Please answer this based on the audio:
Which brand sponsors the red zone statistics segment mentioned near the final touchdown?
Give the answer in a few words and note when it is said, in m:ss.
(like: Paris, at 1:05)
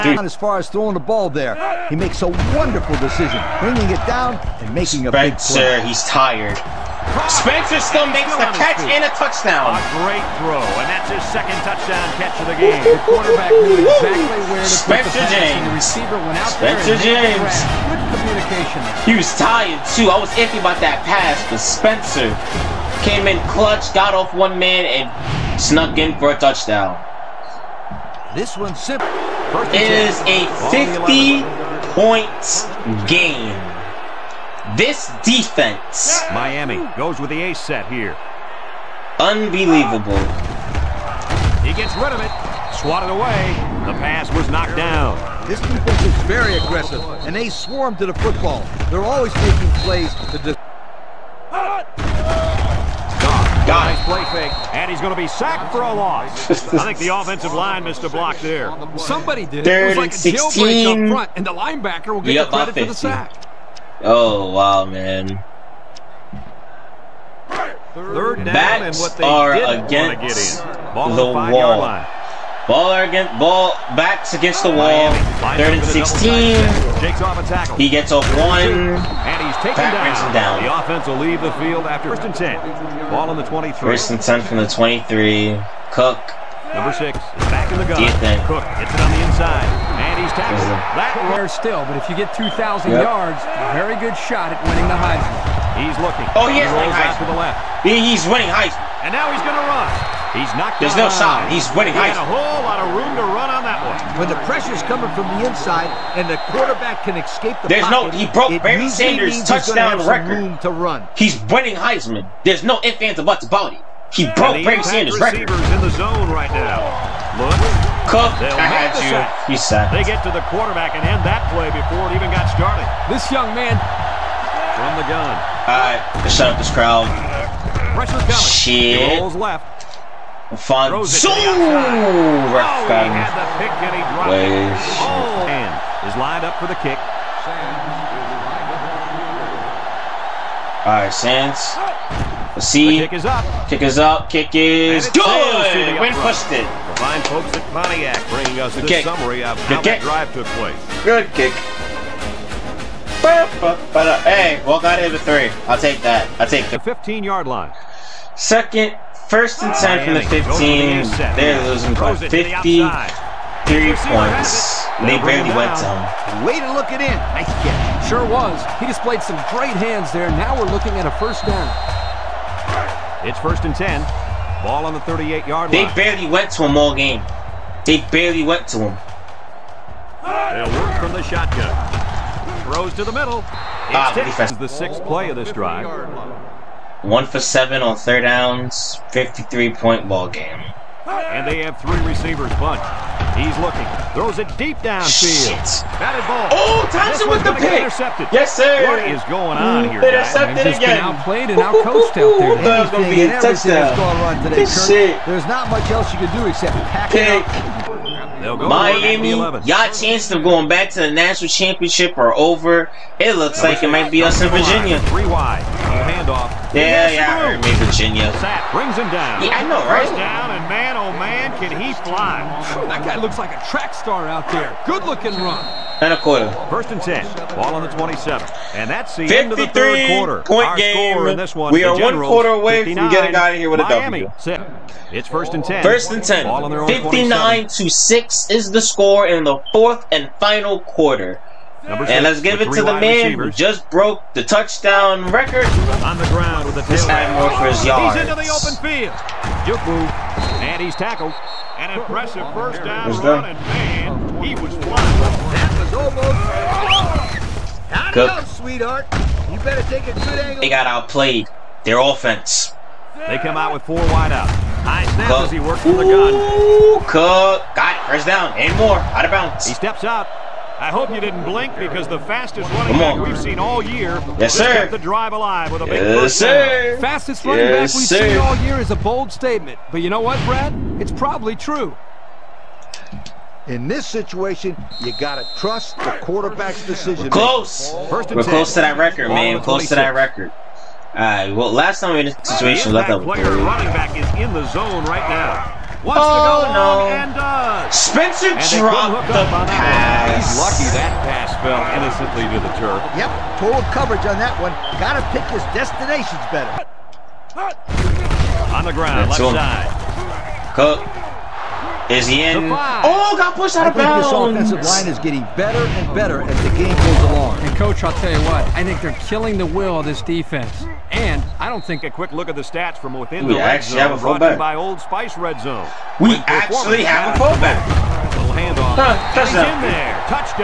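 Old Spice, at 5:24.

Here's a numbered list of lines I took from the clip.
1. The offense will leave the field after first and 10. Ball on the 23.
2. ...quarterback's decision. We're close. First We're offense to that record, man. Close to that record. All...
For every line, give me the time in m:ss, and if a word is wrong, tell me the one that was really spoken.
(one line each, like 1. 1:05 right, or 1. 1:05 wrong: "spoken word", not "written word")
1. 1:20 right
2. 4:46 wrong: "close", not "offense".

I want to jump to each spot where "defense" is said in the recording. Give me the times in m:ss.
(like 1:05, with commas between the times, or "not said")
0:35, 0:45, 5:20.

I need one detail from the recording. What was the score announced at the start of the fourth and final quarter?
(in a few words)
59 to 6.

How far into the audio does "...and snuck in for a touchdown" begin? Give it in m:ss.
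0:24.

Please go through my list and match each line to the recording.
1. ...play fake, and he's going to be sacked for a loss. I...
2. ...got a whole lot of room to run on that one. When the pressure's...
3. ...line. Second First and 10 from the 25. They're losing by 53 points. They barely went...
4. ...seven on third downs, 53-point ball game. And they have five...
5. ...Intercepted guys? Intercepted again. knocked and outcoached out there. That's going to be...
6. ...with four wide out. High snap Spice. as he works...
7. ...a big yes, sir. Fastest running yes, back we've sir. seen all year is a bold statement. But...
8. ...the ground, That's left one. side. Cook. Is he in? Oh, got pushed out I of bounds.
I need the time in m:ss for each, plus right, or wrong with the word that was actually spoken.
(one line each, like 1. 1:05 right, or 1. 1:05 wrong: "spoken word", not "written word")
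1. 0:54 right
2. 1:42 right
3. 2:37 wrong: "15", not "25"
4. 3:07 wrong: "three", not "five"
5. 3:20 wrong: "outplayed", not "knocked"
6. 4:23 wrong: "Cook", not "Spice"
7. 4:35 right
8. 5:08 right.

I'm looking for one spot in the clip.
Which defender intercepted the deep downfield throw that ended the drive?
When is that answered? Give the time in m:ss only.
3:16.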